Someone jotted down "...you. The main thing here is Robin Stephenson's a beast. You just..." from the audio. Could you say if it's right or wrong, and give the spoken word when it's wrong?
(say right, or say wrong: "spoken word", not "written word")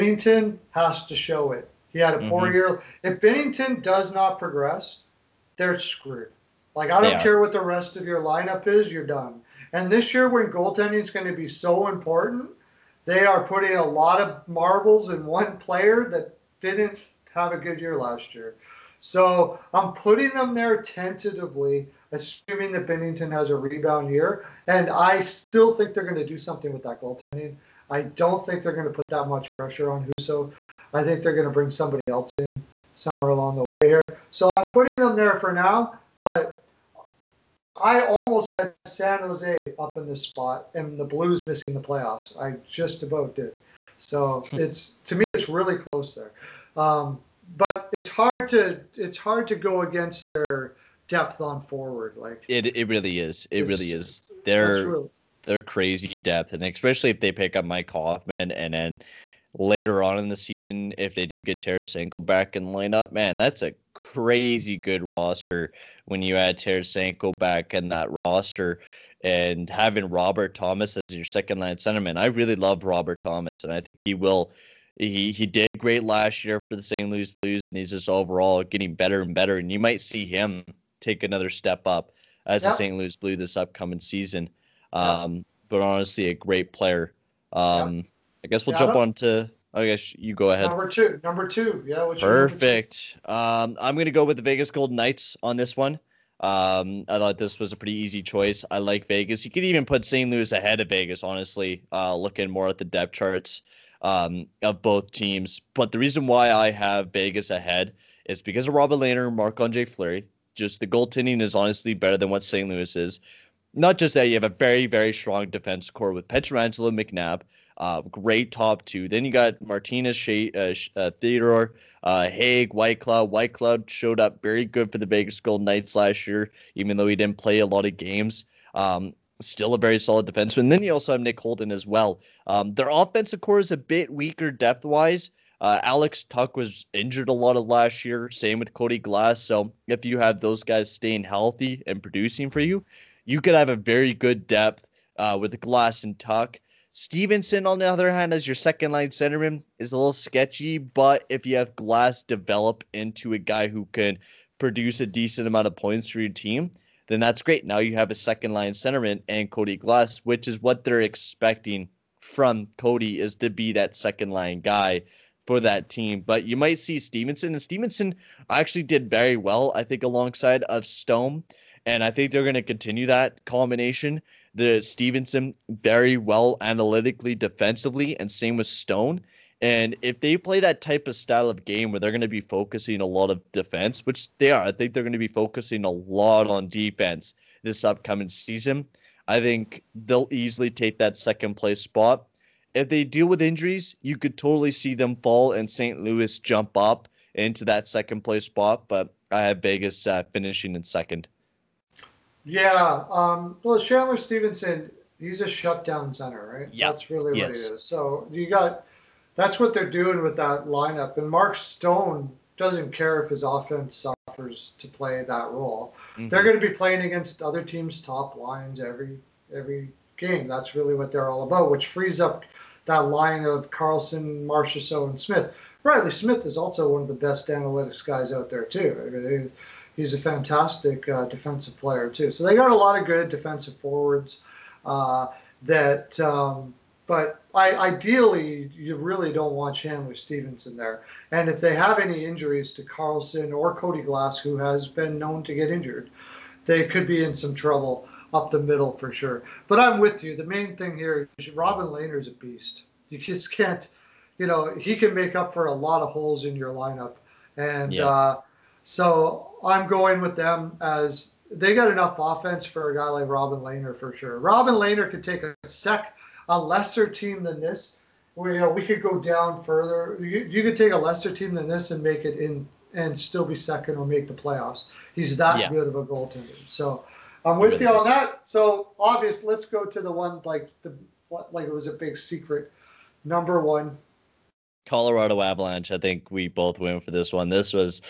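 wrong: "Lehner", not "Stephenson".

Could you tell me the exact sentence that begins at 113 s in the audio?
Not just that, you have a very, very strong defense core with Pietrangelo McNabb, uh, great top two.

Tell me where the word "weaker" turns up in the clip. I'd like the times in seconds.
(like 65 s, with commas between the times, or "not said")
134 s.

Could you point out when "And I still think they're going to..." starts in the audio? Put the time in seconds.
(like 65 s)
24 s.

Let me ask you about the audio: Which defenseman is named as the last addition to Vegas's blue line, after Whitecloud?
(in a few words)
Nick Holden.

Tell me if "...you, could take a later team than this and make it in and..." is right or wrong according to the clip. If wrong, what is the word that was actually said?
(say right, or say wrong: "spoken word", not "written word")
wrong: "lesser", not "later".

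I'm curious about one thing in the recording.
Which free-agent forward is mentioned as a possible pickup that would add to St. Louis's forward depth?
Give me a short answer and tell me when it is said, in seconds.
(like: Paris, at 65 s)
Mike Hoffman, at 57 s.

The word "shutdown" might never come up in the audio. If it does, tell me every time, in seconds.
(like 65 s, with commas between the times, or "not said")
205 s.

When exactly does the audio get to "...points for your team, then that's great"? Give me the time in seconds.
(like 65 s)
155 s.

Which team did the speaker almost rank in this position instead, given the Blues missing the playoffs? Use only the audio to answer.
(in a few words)
San Jose.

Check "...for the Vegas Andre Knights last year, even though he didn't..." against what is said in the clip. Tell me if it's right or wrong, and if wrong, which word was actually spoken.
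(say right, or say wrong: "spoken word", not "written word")
wrong: "Golden", not "Andre".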